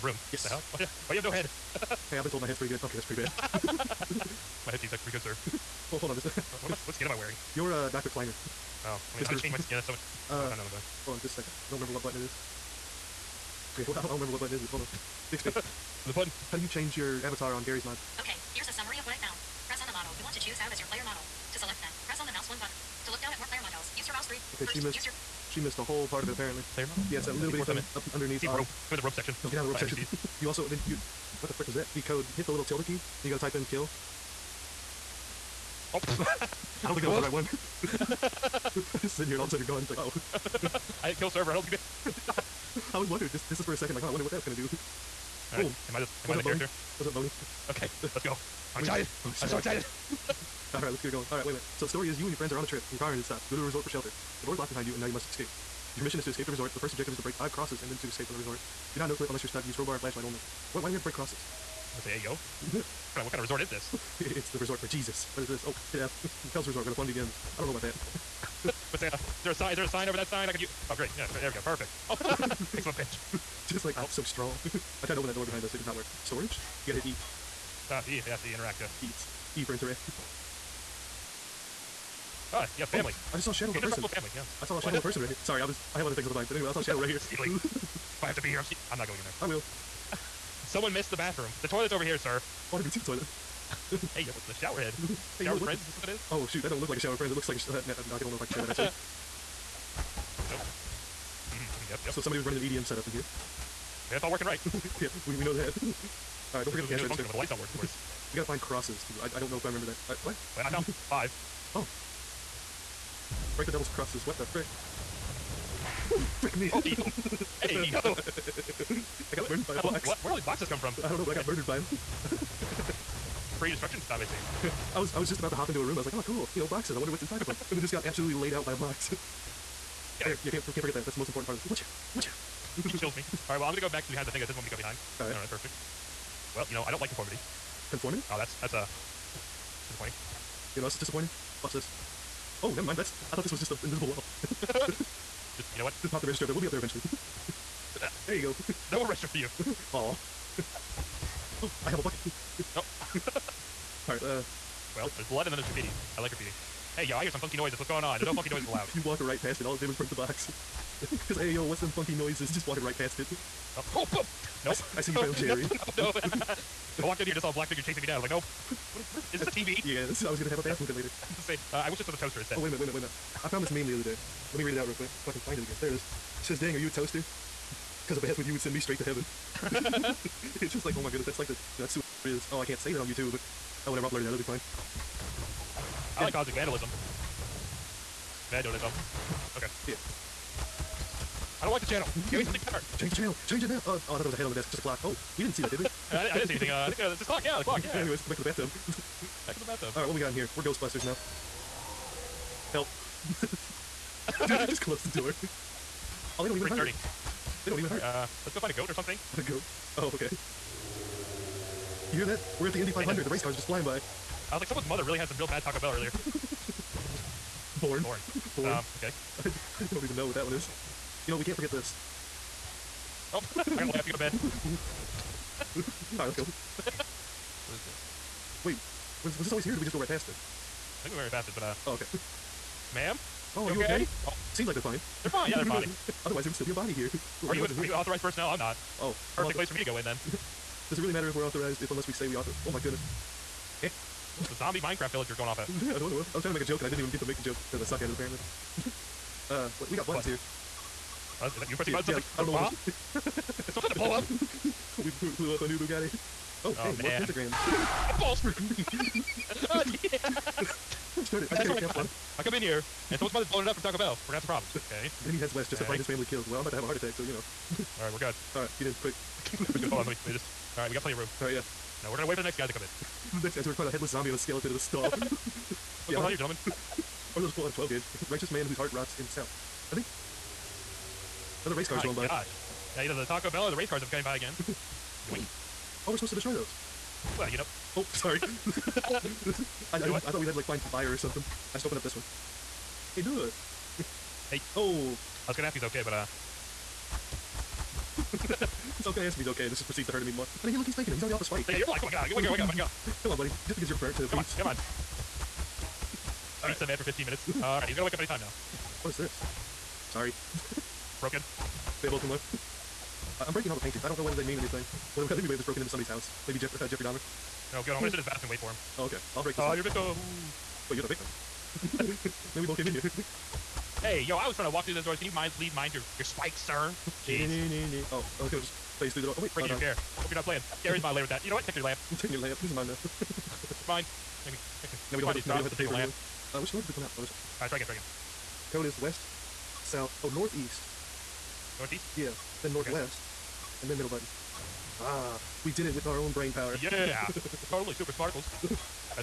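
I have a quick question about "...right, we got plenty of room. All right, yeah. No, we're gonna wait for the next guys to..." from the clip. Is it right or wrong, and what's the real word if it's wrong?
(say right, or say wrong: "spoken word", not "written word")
right.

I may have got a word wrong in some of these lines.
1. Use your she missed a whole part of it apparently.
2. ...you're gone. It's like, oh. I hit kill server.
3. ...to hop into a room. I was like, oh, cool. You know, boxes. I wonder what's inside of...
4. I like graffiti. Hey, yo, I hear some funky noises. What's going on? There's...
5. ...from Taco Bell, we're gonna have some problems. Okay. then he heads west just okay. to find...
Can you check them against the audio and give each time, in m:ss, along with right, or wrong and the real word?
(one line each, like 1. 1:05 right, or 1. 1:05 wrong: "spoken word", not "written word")
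1. 0:24 right
2. 0:39 right
3. 2:05 right
4. 2:36 right
5. 4:23 right.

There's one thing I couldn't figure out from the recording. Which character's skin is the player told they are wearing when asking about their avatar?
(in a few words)
Dr. Kleiner.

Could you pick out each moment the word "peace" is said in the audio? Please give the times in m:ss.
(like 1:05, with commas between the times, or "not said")
5:04.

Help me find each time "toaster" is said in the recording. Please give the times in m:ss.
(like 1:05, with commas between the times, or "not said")
2:52, 2:56.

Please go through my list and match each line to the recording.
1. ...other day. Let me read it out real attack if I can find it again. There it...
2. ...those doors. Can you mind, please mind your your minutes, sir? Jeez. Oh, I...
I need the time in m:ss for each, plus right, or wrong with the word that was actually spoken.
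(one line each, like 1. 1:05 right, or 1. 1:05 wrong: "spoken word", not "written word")
1. 2:53 wrong: "quick", not "attack"
2. 5:24 wrong: "spikes", not "minutes".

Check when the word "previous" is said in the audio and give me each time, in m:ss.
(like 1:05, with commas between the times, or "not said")
not said.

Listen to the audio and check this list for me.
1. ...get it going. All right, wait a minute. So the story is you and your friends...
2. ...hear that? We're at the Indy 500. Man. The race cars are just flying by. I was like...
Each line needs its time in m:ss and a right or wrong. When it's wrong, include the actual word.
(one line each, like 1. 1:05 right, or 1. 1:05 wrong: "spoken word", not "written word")
1. 0:51 right
2. 3:32 right.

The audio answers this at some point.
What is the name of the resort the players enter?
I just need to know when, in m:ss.
1:06.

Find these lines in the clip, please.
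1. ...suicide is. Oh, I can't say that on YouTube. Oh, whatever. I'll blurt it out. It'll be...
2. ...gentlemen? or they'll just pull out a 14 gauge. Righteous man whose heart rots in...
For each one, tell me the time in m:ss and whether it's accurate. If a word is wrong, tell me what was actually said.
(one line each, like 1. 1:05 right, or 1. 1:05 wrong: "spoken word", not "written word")
1. 3:01 right
2. 4:36 wrong: "12", not "14".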